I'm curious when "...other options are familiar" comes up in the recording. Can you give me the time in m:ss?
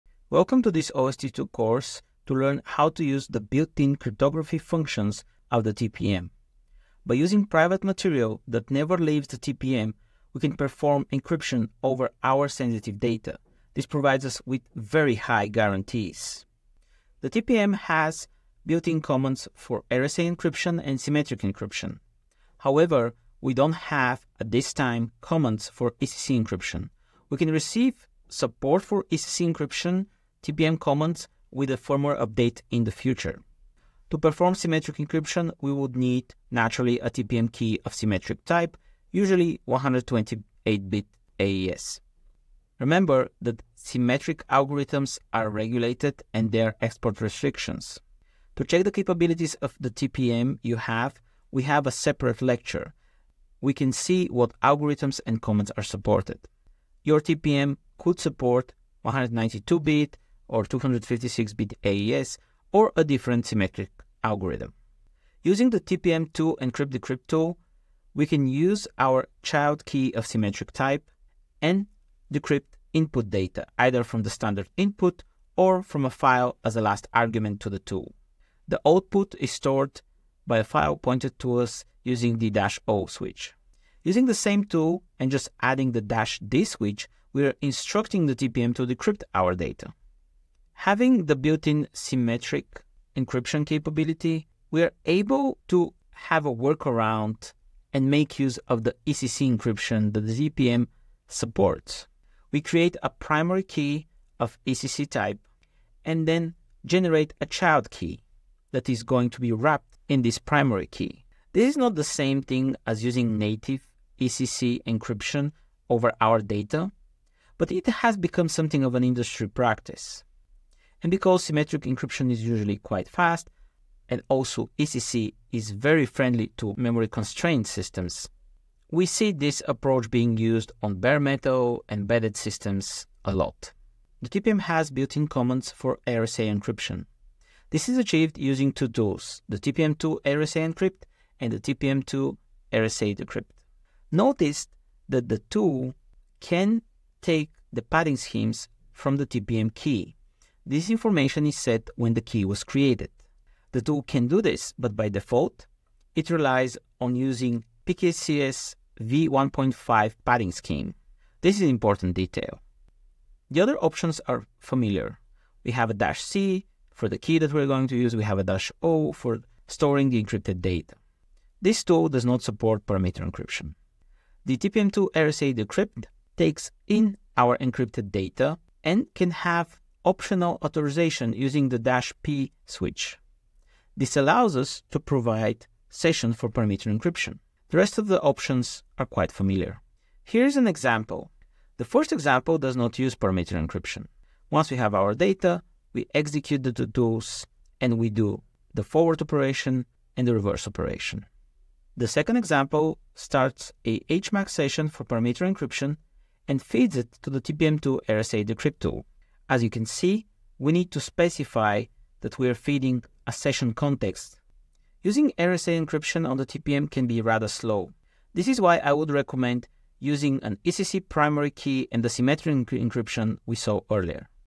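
2:43.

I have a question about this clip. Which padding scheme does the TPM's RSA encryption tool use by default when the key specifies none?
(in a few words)
PKCS v1.5.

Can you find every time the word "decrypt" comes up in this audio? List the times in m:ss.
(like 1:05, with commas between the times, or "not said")
1:06, 1:12, 1:28, 2:23, 2:55, 3:28.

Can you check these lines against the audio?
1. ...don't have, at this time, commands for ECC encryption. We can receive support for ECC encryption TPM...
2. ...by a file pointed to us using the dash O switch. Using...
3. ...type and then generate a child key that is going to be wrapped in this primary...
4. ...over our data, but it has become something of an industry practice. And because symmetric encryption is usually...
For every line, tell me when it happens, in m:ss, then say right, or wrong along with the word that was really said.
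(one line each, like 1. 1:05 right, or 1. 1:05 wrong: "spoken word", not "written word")
1. 0:23 right
2. 1:20 right
3. 1:45 right
4. 1:55 right.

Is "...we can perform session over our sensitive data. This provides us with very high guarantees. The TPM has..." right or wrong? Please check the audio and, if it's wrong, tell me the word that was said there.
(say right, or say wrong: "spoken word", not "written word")
wrong: "encryption", not "session".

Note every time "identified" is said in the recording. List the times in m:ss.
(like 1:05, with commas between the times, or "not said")
not said.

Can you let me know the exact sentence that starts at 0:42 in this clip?
Remember that symmetric algorithms are regulated and there are export restrictions.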